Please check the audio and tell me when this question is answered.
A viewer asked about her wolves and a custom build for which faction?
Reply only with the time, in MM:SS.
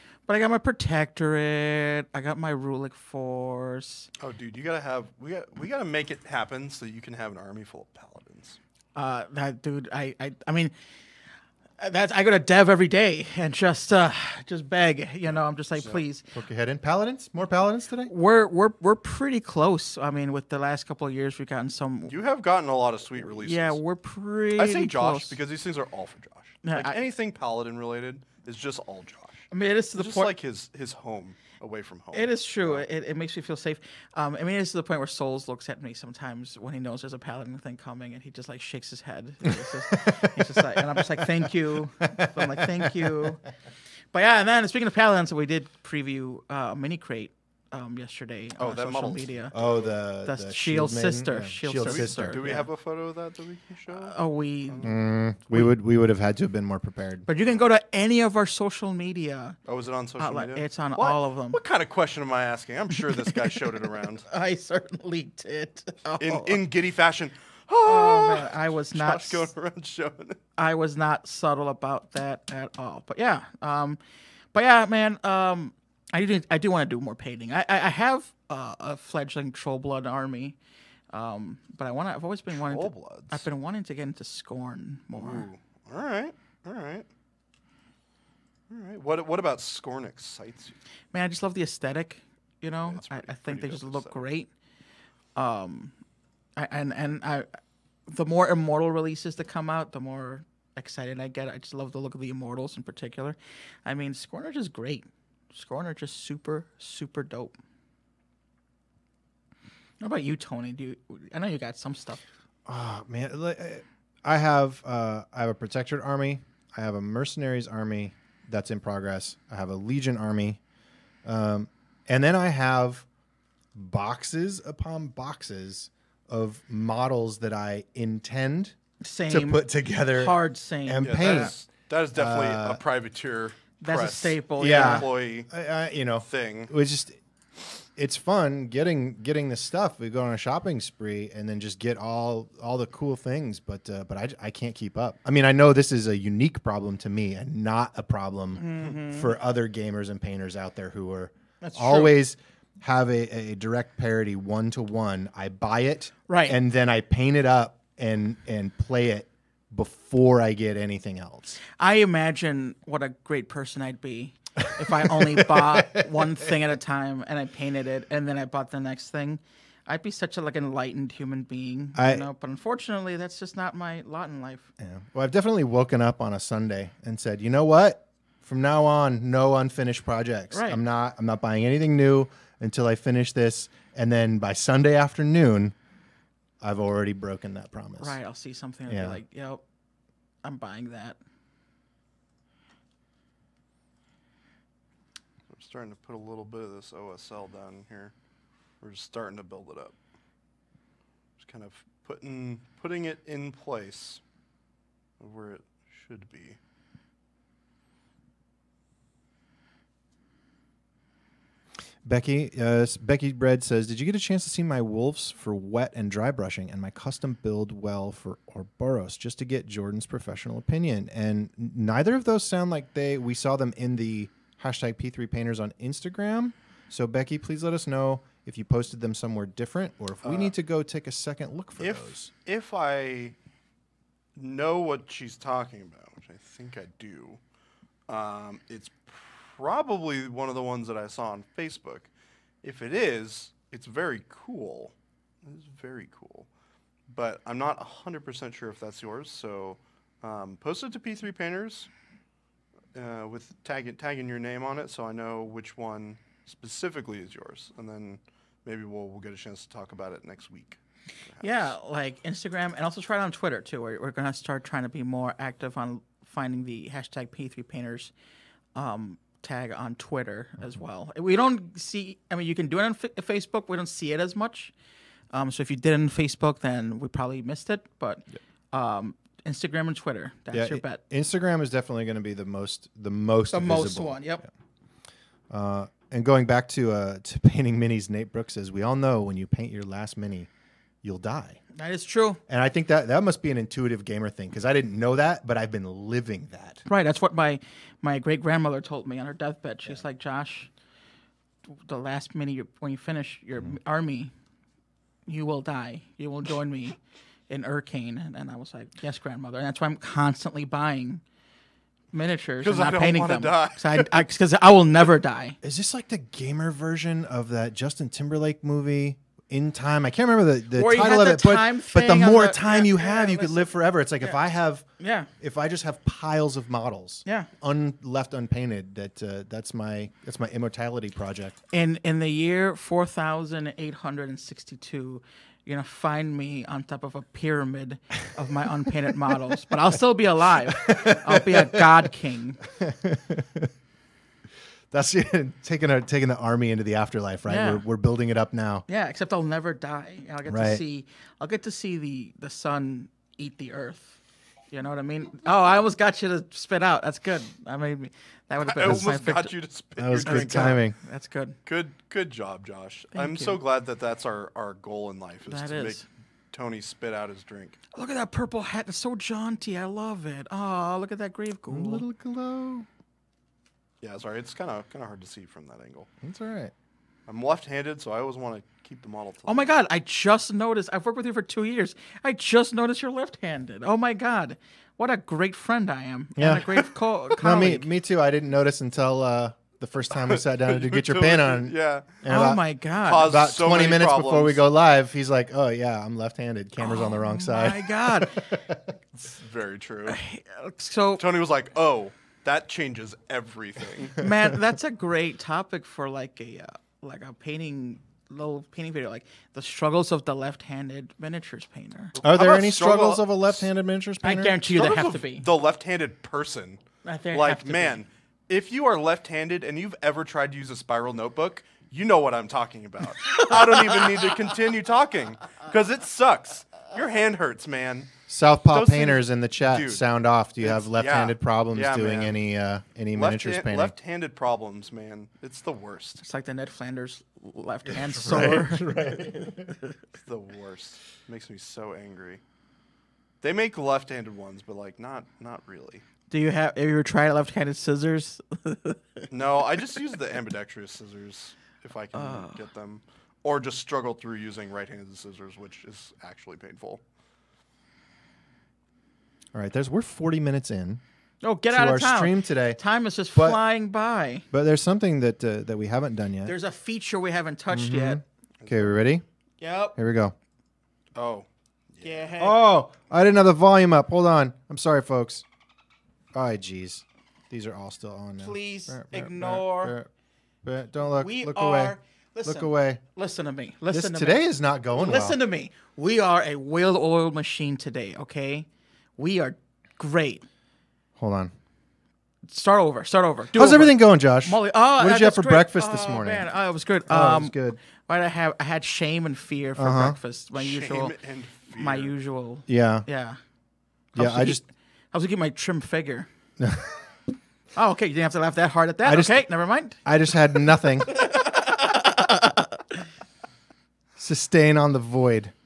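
03:38.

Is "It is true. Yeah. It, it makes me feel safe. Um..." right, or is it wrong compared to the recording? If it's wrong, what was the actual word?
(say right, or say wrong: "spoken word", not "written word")
right.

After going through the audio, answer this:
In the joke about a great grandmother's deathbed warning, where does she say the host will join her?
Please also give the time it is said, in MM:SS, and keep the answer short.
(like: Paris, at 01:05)
Urcaen, at 05:07.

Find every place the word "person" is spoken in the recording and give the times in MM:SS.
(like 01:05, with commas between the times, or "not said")
02:43, 06:56.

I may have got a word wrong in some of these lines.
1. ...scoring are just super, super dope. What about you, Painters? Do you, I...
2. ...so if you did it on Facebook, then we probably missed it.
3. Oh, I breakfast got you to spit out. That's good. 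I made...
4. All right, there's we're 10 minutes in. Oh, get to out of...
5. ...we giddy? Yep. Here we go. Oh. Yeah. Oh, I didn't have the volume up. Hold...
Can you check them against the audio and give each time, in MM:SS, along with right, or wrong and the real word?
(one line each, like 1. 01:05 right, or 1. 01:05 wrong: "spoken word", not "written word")
1. 01:45 wrong: "Tony", not "Painters"
2. 04:35 right
3. 05:55 wrong: "almost", not "breakfast"
4. 07:39 wrong: "40", not "10"
5. 07:48 wrong: "ready", not "giddy".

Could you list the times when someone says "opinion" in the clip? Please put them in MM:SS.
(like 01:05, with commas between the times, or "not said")
03:40.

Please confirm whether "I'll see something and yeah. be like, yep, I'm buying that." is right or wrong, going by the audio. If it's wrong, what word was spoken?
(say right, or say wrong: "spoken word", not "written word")
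right.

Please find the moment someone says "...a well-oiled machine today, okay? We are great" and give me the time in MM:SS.
08:06.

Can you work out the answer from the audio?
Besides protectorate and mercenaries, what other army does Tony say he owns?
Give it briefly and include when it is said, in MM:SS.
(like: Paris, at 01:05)
Legion, at 01:59.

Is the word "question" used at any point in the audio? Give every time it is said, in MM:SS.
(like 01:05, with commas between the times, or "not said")
01:01.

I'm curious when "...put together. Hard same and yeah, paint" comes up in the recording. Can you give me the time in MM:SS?
02:09.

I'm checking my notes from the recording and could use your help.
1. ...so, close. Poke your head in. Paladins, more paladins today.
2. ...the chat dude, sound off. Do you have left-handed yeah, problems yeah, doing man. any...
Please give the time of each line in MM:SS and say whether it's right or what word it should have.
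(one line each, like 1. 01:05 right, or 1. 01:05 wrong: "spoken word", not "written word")
1. 00:15 wrong: "please", not "close"
2. 07:09 right.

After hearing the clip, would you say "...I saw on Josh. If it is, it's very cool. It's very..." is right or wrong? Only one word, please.
wrong.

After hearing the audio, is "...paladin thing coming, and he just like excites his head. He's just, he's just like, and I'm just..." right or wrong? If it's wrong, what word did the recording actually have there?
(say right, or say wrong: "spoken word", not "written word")
wrong: "shakes", not "excites".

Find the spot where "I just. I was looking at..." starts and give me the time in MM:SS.
08:24.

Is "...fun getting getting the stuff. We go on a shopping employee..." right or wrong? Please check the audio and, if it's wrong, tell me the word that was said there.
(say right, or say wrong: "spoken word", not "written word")
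wrong: "spree", not "employee".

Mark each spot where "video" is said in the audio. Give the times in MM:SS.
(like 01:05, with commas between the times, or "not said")
06:48.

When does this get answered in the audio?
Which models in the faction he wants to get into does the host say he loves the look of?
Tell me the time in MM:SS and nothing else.
01:42.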